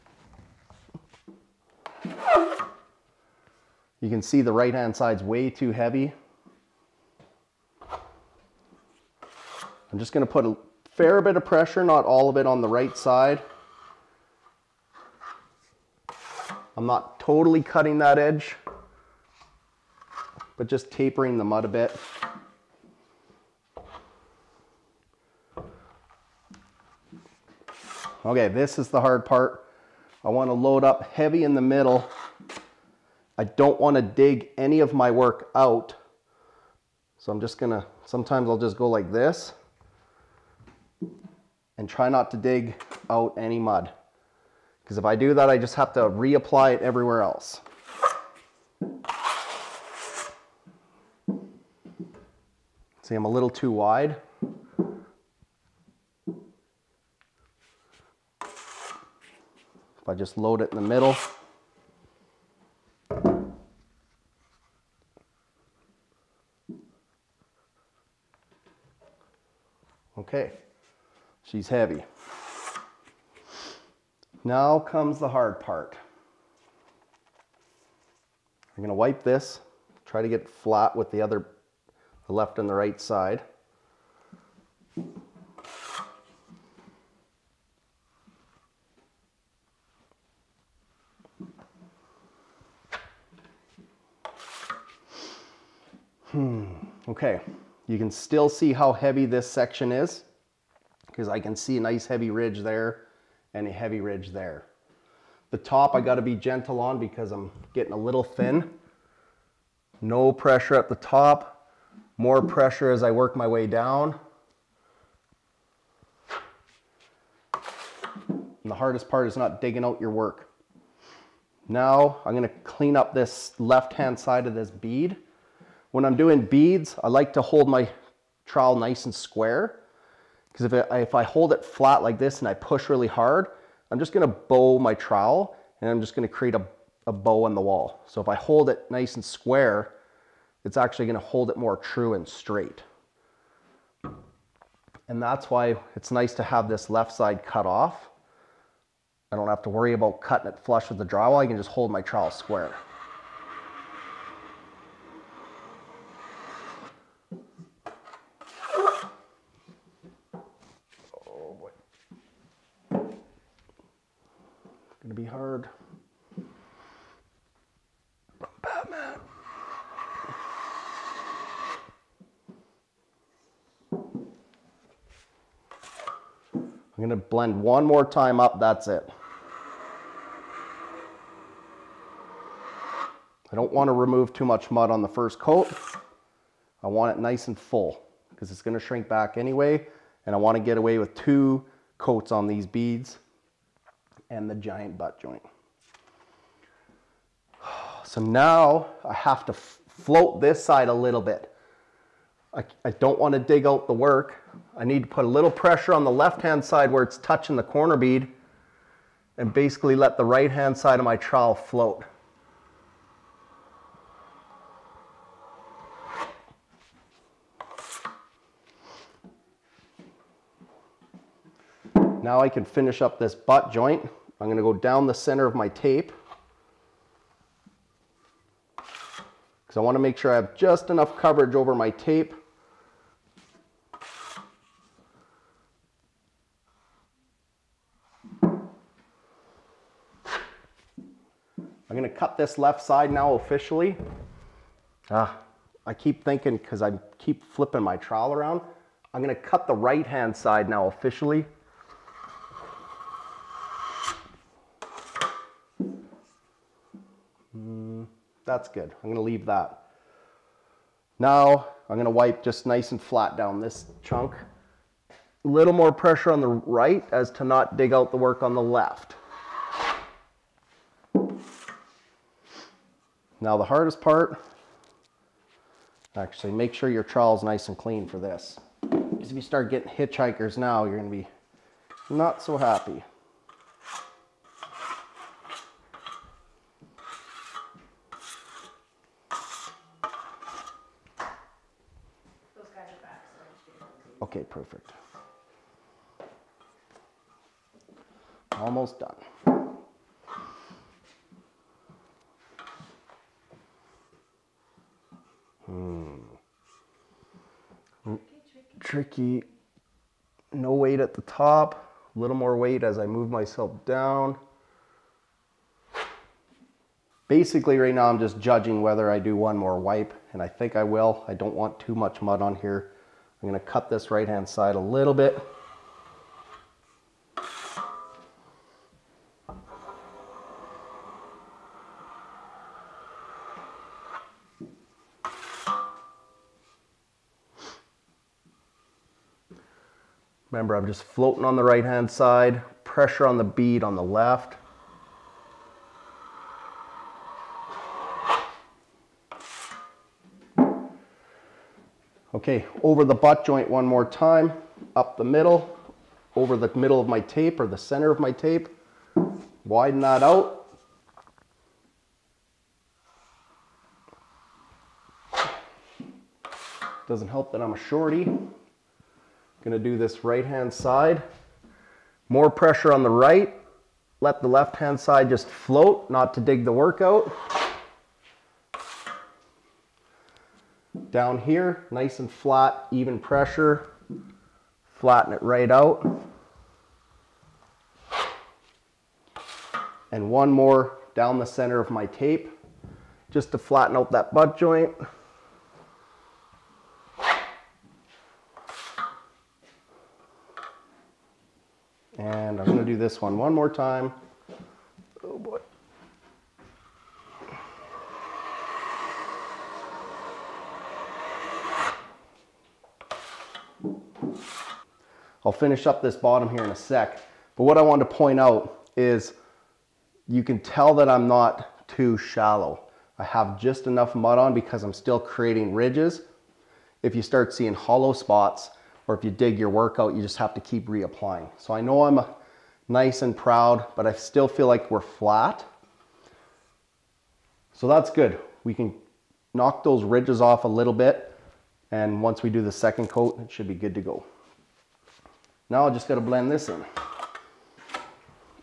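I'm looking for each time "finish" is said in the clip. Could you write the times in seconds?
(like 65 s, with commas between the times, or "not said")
222 s, 415 s.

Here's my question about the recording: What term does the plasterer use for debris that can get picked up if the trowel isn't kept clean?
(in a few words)
hitchhikers.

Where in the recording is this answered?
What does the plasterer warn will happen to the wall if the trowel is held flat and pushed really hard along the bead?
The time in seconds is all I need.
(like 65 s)
136 s.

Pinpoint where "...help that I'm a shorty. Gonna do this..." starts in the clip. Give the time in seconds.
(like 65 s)
367 s.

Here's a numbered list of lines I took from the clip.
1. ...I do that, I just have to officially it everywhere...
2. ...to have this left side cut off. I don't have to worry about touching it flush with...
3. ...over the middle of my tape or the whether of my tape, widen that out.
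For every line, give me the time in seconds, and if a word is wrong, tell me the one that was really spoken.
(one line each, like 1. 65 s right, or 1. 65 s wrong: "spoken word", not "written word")
1. 45 s wrong: "reapply", not "officially"
2. 146 s wrong: "cutting", not "touching"
3. 356 s wrong: "center", not "whether".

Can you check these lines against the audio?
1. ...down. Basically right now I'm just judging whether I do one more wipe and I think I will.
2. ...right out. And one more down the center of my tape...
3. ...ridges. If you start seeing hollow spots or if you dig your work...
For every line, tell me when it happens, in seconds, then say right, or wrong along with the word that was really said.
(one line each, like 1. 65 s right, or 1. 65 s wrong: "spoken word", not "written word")
1. 313 s right
2. 385 s right
3. 425 s right.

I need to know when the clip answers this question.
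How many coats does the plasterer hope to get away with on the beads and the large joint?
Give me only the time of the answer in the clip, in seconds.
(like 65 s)
191 s.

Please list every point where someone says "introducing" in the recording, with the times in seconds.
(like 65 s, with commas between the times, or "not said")
not said.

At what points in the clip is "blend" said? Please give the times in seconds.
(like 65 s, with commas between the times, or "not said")
177 s, 446 s.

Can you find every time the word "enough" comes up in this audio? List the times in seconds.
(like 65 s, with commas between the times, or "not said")
230 s, 423 s.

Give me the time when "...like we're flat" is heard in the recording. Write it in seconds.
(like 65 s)
434 s.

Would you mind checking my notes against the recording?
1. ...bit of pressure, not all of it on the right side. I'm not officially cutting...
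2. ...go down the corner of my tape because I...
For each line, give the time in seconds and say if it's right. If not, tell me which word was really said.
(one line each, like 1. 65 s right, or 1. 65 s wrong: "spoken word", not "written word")
1. 11 s wrong: "totally", not "officially"
2. 224 s wrong: "center", not "corner".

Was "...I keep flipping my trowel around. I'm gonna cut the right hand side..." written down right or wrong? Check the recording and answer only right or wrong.
right.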